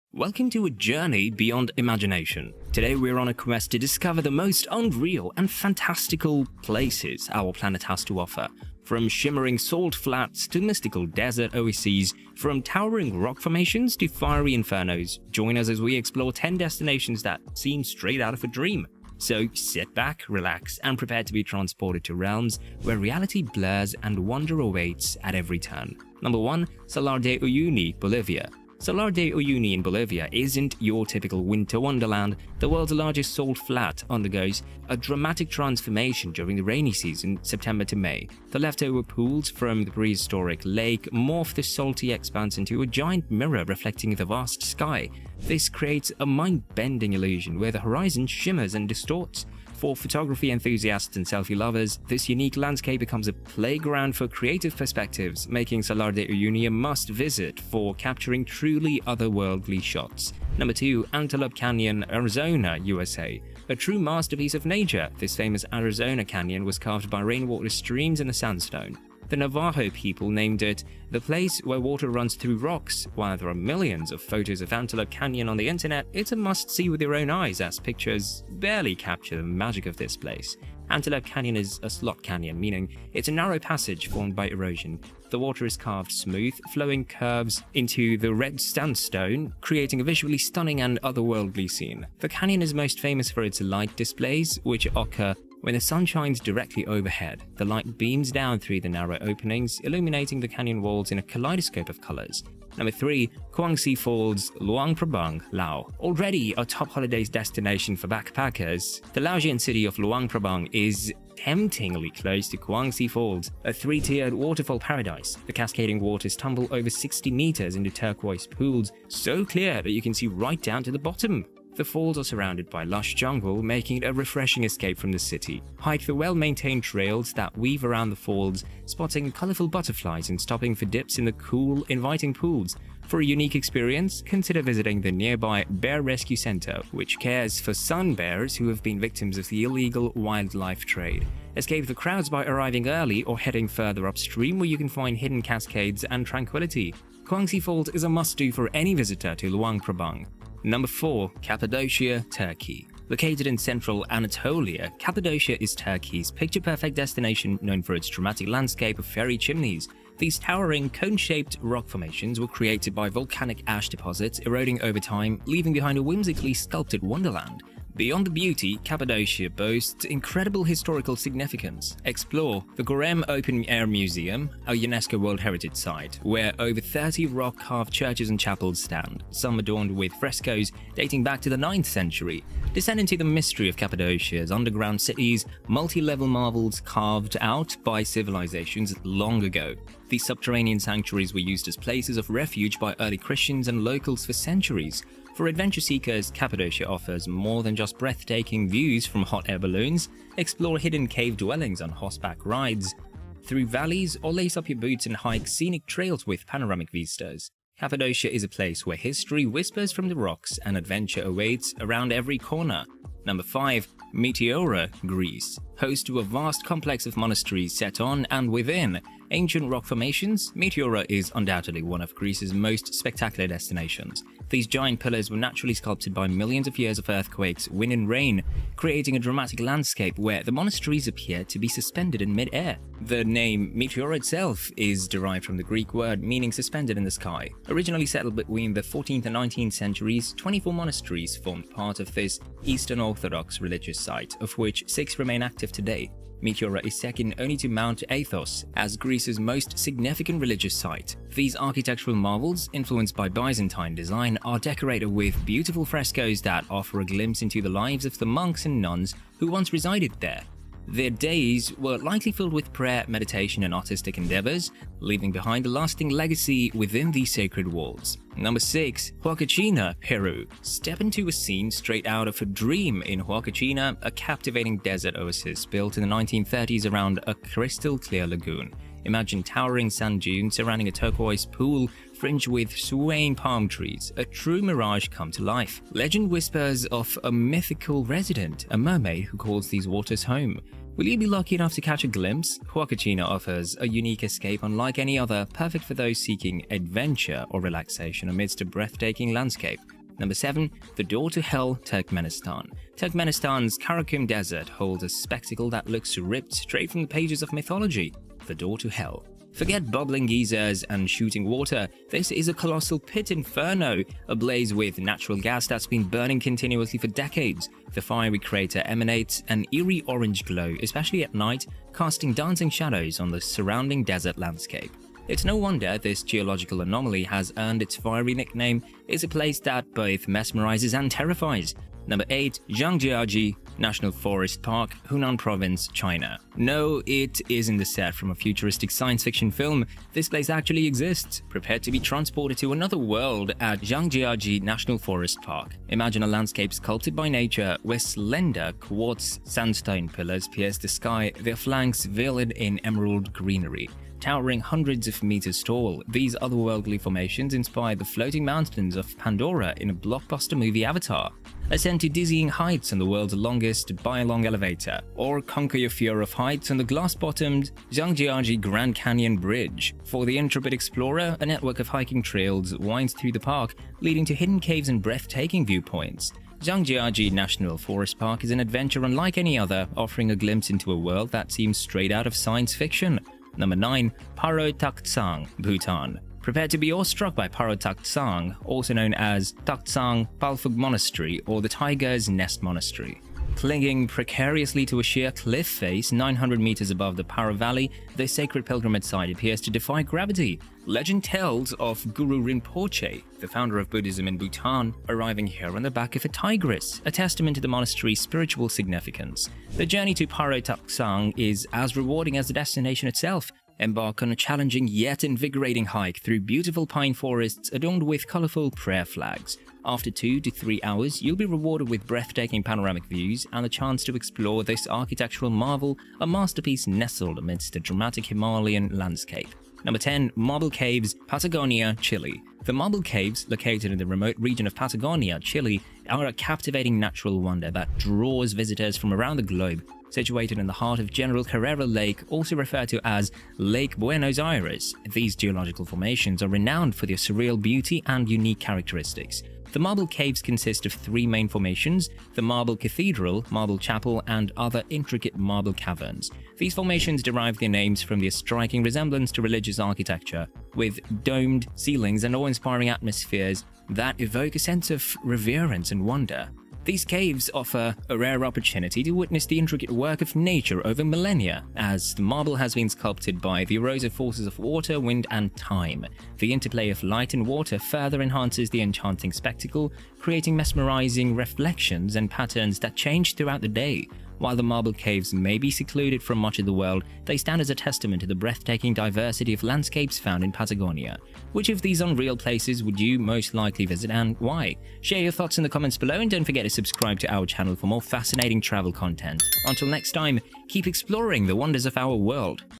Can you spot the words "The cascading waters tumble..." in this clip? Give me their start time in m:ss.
1:55.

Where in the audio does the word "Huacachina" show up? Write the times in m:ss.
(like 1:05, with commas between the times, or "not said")
4:29, 4:33, 4:52.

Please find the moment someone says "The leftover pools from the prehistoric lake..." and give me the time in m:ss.
0:38.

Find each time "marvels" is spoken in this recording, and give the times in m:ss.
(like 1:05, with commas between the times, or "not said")
3:06, 4:12, 7:05.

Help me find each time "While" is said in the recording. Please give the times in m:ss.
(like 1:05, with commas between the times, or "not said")
1:13, 8:04.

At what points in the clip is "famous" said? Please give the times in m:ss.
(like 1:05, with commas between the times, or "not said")
1:05, 1:32.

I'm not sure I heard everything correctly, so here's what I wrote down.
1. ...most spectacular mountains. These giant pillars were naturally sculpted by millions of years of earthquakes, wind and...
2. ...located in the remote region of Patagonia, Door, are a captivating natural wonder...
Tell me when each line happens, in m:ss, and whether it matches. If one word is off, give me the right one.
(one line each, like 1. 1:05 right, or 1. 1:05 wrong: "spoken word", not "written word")
1. 3:42 wrong: "destinations", not "mountains"
2. 7:13 wrong: "Chile", not "Door".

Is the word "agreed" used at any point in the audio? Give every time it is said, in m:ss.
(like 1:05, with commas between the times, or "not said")
not said.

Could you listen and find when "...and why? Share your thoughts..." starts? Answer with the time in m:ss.
8:14.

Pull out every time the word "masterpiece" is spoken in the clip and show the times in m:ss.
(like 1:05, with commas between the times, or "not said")
1:03, 7:06.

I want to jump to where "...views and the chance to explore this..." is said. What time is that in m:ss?
7:03.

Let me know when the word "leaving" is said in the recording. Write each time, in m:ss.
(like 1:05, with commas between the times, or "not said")
2:45, 4:24.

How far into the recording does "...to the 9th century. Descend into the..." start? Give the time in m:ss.
3:01.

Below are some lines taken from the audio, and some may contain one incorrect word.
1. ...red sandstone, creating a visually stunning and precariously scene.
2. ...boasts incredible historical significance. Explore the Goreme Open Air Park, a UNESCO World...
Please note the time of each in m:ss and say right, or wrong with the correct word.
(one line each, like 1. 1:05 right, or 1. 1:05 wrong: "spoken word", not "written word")
1. 1:28 wrong: "otherworldly", not "precariously"
2. 2:49 wrong: "Museum", not "Park".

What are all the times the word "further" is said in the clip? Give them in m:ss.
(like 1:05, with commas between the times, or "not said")
2:23, 7:57.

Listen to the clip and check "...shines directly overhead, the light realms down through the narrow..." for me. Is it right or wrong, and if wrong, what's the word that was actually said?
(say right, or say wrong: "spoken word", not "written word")
wrong: "beams", not "realms".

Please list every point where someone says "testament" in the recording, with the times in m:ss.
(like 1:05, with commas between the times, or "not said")
6:47, 8:07.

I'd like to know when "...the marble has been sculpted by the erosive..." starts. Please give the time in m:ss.
7:52.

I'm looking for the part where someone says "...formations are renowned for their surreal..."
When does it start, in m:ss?
7:25.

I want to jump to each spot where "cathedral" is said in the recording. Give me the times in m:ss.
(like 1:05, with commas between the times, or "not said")
7:32.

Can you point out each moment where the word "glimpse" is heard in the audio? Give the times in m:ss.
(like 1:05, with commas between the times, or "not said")
4:17, 4:52, 6:20.